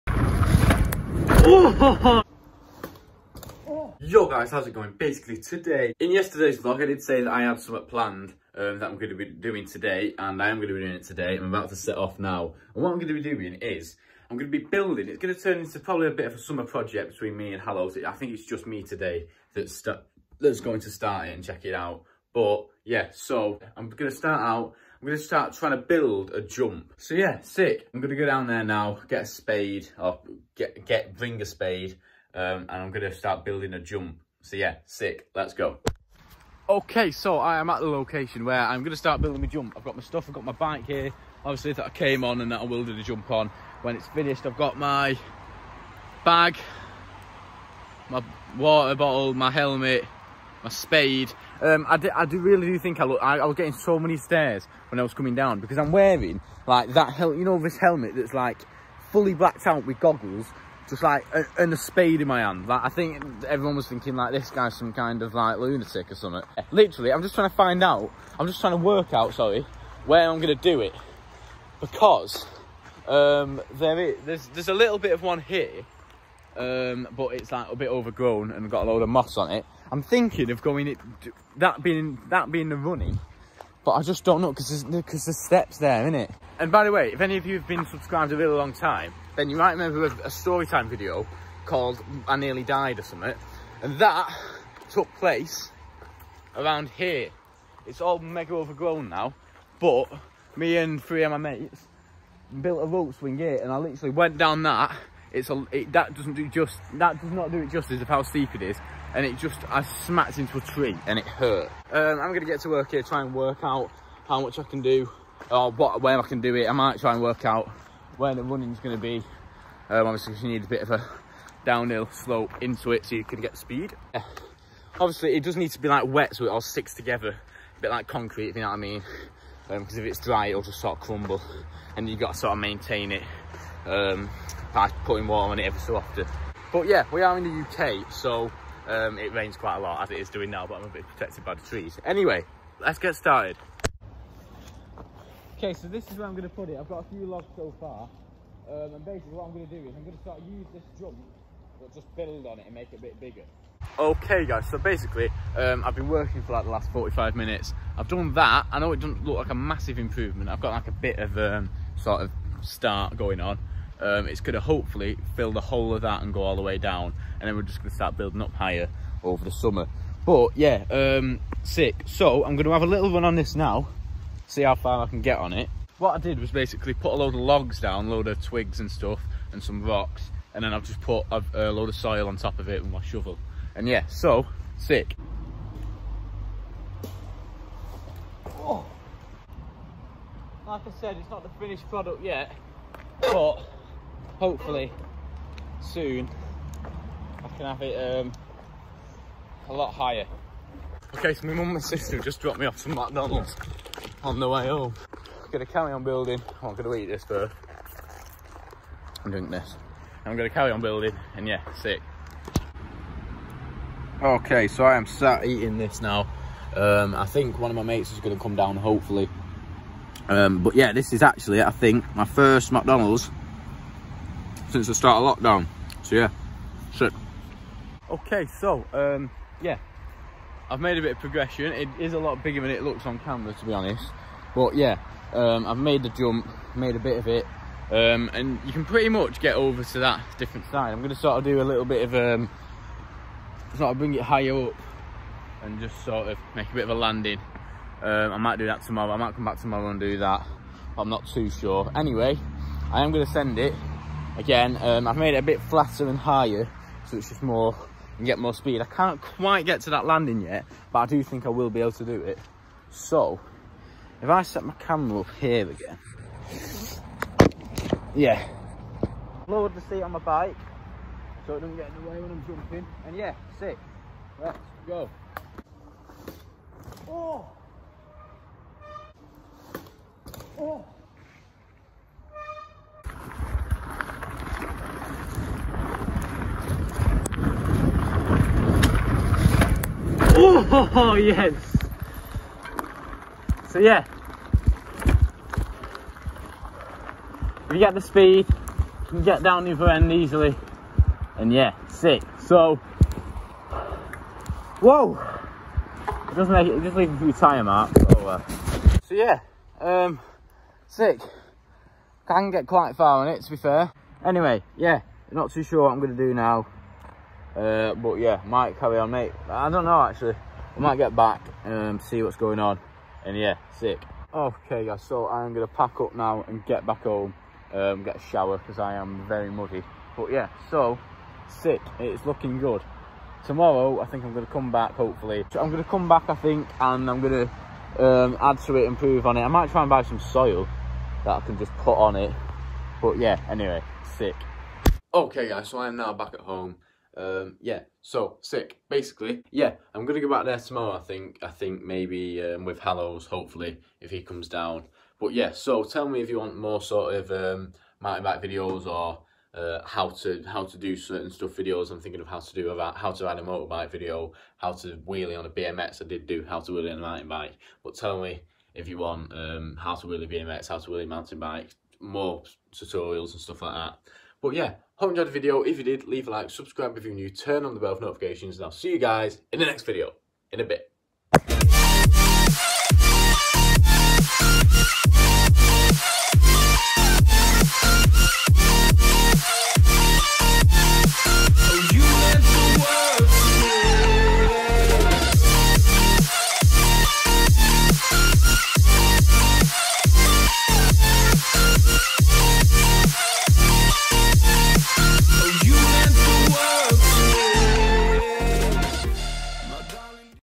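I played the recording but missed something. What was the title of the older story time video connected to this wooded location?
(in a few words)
I Nearly Died.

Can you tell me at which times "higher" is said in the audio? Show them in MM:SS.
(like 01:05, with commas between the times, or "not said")
02:48, 03:19, 04:04, 04:16.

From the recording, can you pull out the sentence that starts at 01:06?
Literally, I'm just trying to find out.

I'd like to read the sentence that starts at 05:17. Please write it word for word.
Uh, but yeah, might carry on, mate.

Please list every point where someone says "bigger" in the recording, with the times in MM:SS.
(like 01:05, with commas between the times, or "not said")
02:33, 03:52.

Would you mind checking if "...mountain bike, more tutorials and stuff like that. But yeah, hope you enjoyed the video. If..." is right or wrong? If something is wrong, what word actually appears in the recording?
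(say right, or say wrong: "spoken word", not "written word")
right.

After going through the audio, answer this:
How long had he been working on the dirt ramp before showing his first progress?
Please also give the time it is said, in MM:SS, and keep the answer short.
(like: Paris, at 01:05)
45 minutes, at 02:36.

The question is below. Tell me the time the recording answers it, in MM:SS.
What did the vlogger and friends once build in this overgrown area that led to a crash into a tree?
01:42.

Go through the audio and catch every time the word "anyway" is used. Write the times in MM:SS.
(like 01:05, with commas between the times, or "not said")
02:22, 04:11, 05:14, 05:43.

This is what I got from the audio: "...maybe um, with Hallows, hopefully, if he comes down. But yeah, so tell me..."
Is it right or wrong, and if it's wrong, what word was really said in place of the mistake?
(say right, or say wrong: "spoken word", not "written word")
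right.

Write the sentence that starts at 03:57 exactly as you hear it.
Um, and you can pretty much get over to that different side.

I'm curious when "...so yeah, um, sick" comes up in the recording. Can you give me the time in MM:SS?
05:09.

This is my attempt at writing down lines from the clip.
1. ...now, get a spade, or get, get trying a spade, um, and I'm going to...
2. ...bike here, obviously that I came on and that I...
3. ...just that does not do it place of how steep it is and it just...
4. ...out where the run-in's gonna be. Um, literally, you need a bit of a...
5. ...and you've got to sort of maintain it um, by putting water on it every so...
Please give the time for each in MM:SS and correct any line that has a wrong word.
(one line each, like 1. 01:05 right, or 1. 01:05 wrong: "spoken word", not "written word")
1. 00:28 wrong: "bring", not "trying"
2. 00:40 right
3. 01:46 wrong: "justice", not "place"
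4. 01:57 wrong: "obviously", not "literally"
5. 02:11 right.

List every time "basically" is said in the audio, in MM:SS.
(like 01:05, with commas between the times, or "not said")
00:04, 02:29, 02:34, 02:56, 05:48.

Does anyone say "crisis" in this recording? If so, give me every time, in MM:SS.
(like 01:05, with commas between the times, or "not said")
not said.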